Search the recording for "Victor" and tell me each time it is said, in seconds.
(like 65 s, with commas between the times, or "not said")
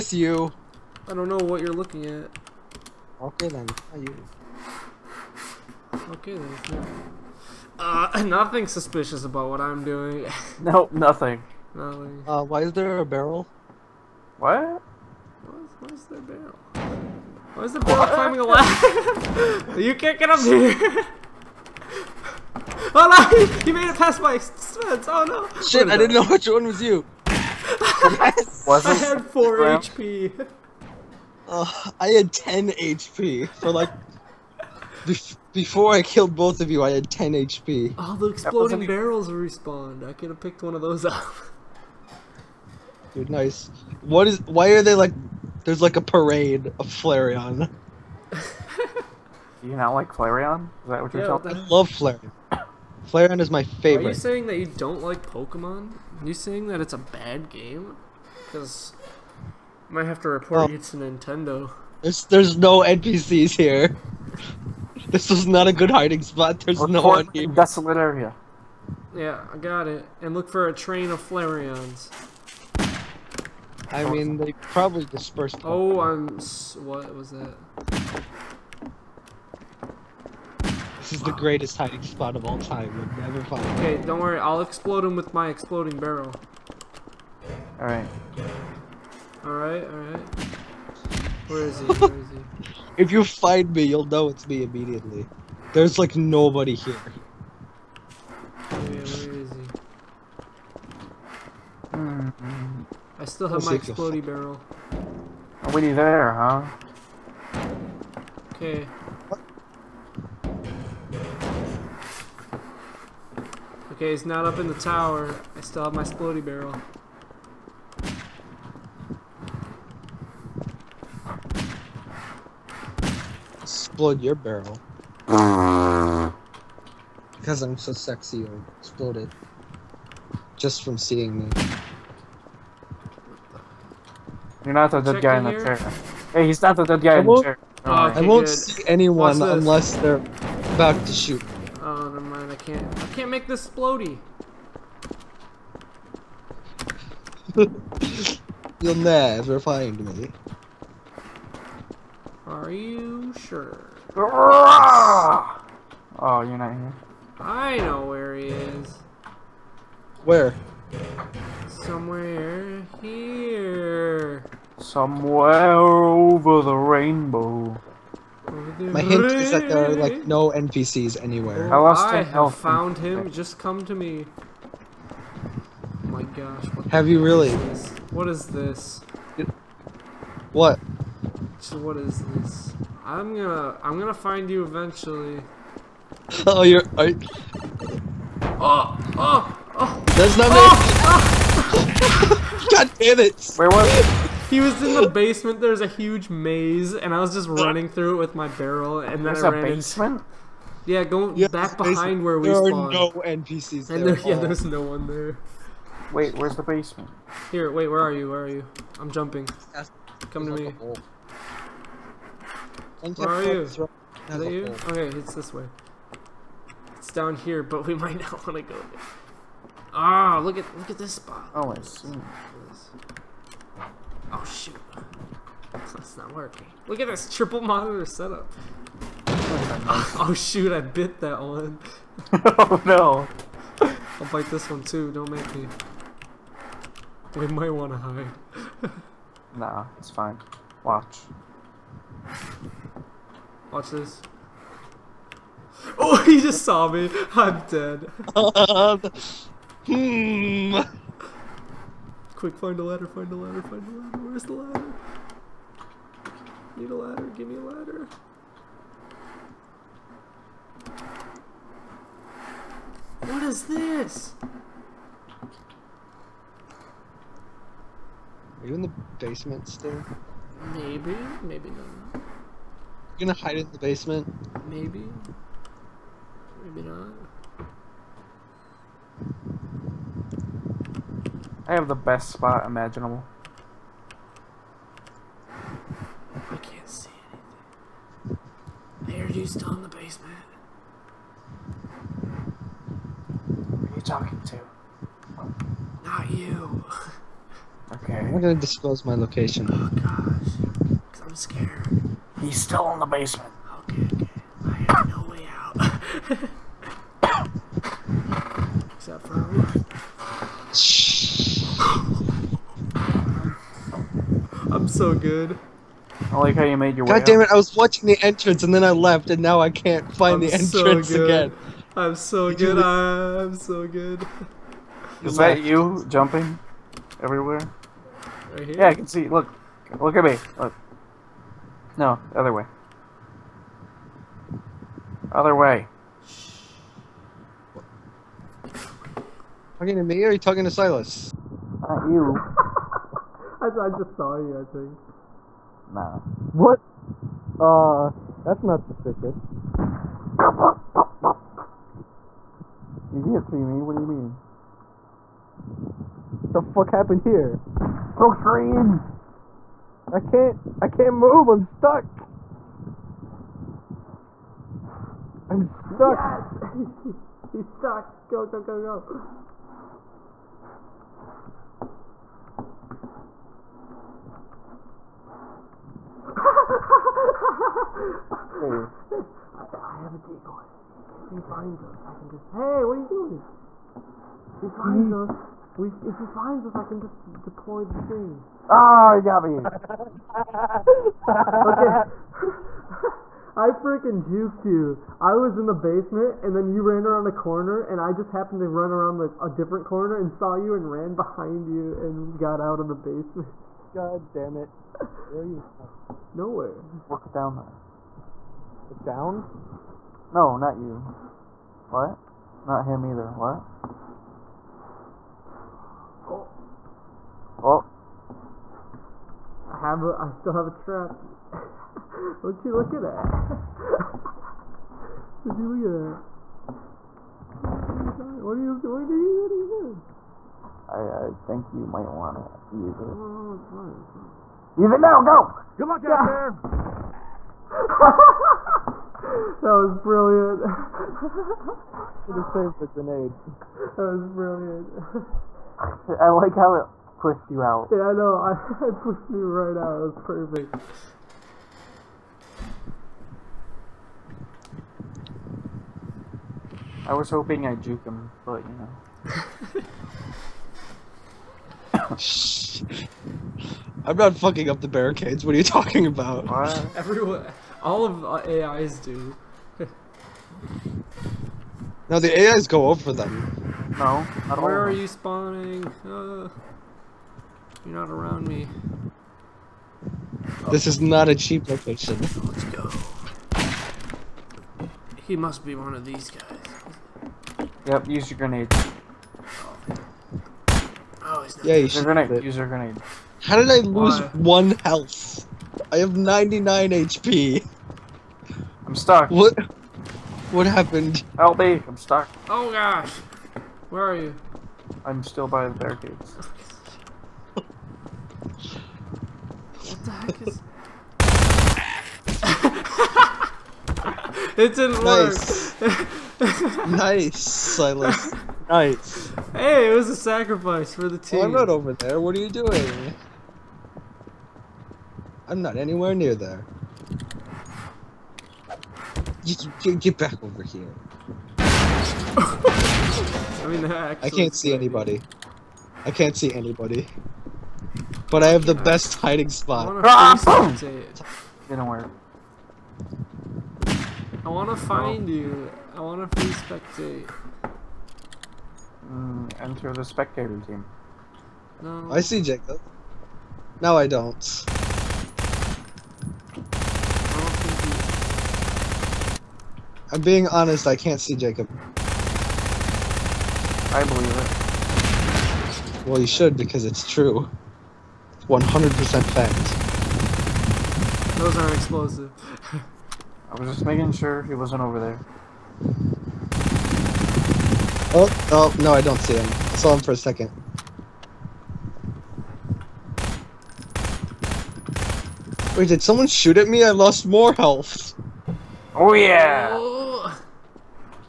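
not said.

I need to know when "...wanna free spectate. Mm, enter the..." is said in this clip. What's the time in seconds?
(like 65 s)
546 s.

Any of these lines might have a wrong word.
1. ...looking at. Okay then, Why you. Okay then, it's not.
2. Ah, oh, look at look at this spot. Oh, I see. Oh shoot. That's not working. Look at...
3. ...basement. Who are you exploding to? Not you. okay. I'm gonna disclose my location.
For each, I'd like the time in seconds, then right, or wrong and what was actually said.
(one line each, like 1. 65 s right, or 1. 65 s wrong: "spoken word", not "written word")
1. 1 s wrong: "Are", not "Why"
2. 219 s right
3. 289 s wrong: "talking", not "exploding".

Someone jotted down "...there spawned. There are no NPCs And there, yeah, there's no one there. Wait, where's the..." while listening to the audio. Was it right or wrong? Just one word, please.
right.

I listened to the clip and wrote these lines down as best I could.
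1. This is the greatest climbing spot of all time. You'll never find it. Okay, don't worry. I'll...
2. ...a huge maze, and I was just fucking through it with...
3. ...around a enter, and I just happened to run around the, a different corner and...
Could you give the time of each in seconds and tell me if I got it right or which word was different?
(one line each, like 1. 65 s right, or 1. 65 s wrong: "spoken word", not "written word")
1. 81 s wrong: "hiding", not "climbing"
2. 195 s wrong: "running", not "fucking"
3. 397 s wrong: "corner", not "enter".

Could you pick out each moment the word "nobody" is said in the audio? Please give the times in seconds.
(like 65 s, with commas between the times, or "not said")
96 s.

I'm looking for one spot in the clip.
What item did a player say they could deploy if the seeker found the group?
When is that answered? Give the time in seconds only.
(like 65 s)
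379 s.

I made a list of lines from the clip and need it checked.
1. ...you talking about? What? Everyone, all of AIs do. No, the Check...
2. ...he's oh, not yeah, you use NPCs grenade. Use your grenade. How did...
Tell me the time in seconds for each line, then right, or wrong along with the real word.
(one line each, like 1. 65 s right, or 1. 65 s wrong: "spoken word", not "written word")
1. 465 s wrong: "AIs", not "Check"
2. 490 s wrong: "Your", not "NPCs".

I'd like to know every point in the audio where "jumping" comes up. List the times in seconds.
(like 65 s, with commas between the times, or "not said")
209 s, 326 s.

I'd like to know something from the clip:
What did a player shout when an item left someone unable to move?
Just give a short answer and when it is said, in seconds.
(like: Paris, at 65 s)
Smoke screen, at 358 s.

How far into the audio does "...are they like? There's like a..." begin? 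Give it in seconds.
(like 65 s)
44 s.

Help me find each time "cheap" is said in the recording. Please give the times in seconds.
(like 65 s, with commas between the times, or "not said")
481 s.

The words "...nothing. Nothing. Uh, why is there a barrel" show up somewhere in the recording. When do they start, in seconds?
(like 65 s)
10 s.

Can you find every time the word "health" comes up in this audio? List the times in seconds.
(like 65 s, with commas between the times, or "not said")
494 s, 587 s.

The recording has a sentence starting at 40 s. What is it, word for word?
I could have picked one of those up.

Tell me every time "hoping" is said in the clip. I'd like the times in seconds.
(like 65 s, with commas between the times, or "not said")
457 s.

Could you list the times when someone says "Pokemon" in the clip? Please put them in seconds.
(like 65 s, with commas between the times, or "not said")
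55 s, 75 s.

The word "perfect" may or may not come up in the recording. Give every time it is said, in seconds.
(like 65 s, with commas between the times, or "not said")
450 s.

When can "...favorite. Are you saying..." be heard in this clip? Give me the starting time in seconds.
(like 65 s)
53 s.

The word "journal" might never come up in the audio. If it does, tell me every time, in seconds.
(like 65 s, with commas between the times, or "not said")
not said.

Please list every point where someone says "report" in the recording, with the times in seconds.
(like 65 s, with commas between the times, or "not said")
60 s, 66 s.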